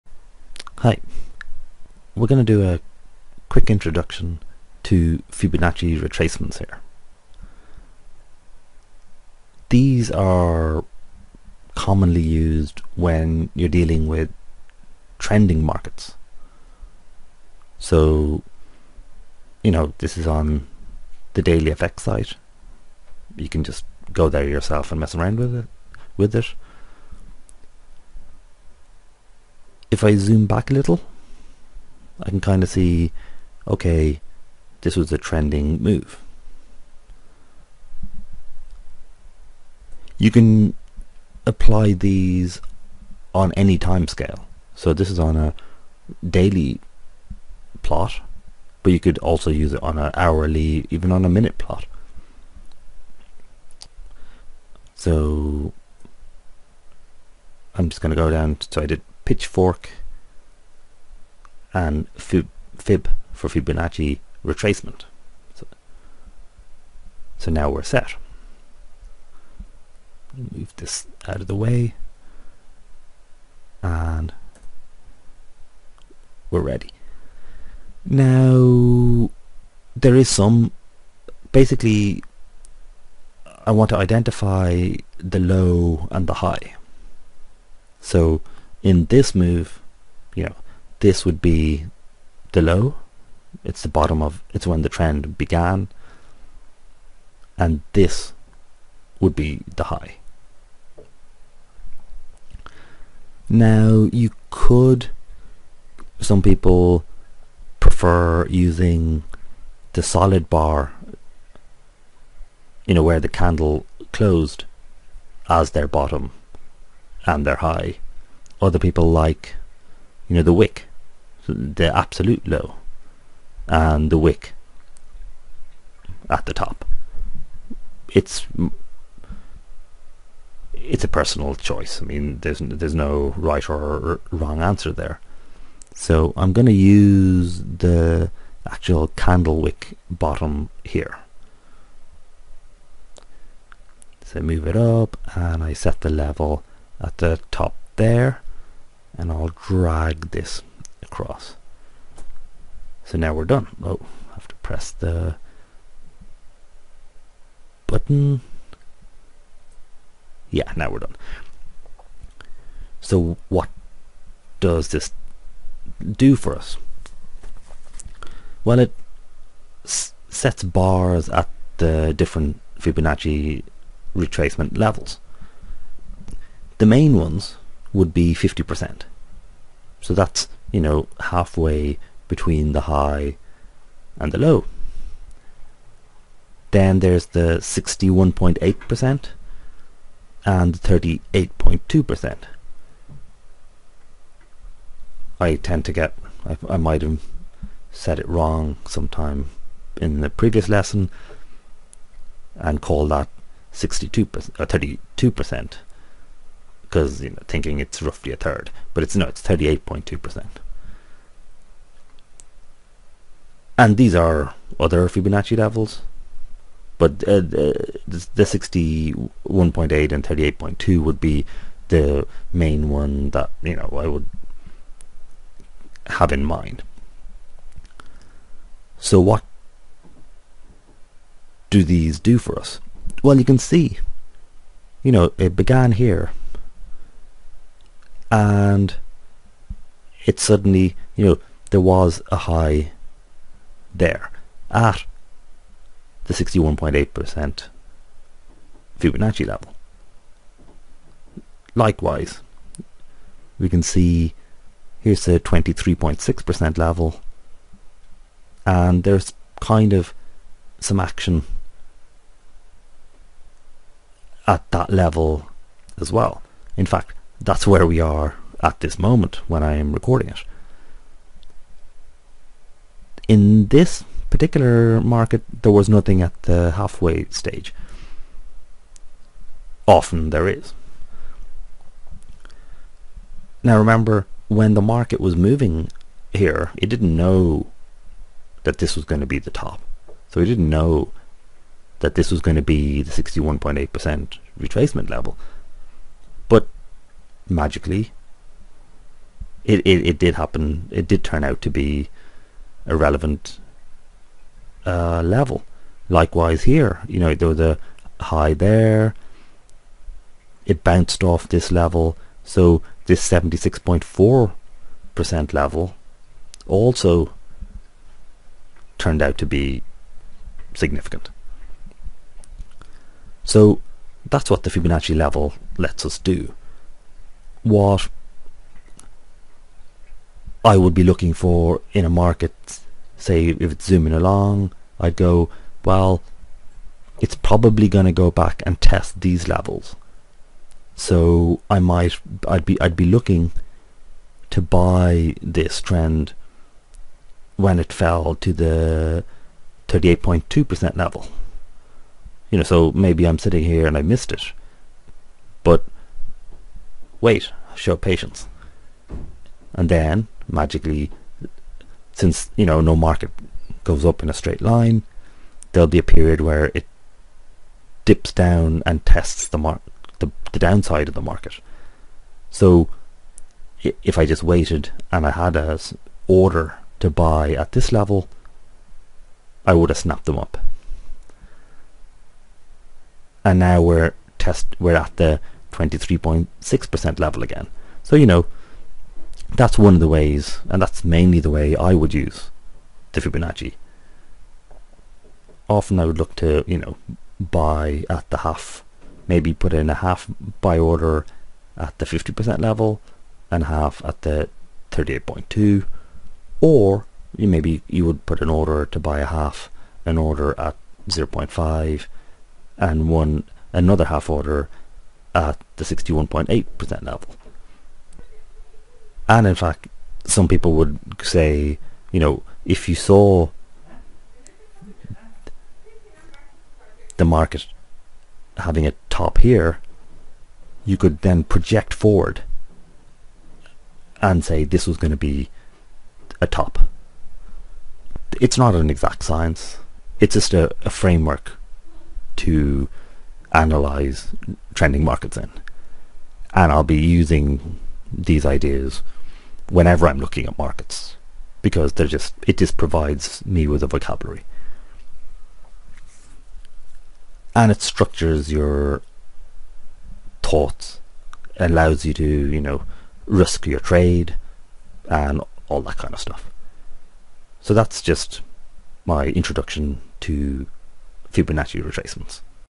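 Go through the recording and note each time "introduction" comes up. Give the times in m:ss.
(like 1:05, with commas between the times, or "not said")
0:03, 7:49.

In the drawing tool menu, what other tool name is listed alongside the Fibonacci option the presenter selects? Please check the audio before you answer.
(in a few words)
pitchfork.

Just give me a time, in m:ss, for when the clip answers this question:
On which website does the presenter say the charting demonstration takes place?
0:21.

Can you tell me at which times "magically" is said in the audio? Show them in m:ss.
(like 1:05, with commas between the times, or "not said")
4:57, 6:00.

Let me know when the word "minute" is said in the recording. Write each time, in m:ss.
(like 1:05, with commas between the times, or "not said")
0:51.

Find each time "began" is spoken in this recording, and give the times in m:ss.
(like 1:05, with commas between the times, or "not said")
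1:35, 3:55.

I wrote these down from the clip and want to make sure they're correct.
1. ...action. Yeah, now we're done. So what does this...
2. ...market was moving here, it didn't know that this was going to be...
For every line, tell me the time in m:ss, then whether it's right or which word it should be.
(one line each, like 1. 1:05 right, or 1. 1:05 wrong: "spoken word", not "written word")
1. 2:37 wrong: "button", not "action"
2. 4:44 right.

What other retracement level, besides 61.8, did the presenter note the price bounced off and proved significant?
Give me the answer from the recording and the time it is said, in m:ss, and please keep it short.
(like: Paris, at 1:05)
76.4%, at 5:13.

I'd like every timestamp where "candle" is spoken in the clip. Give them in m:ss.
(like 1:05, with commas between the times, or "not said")
1:53, 2:19.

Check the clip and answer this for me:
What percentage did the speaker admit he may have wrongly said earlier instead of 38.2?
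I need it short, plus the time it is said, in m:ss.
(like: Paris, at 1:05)
32%, at 3:24.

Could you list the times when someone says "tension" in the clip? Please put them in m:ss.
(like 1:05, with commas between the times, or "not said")
not said.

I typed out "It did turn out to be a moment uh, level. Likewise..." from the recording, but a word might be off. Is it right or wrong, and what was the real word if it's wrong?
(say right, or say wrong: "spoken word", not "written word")
wrong: "relevant", not "moment".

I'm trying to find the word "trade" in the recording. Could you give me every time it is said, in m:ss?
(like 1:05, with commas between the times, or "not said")
7:43.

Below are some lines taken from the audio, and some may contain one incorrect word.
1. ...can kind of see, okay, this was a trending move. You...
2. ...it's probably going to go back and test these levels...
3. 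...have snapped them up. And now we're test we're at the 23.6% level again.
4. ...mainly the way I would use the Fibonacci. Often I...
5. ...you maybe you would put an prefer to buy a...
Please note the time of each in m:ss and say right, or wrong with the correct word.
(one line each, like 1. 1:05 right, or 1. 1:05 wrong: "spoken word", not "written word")
1. 0:32 right
2. 5:37 right
3. 6:19 right
4. 6:31 right
5. 6:47 wrong: "order", not "prefer".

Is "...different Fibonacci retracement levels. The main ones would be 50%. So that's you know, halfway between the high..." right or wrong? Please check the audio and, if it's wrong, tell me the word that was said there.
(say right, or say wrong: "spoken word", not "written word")
right.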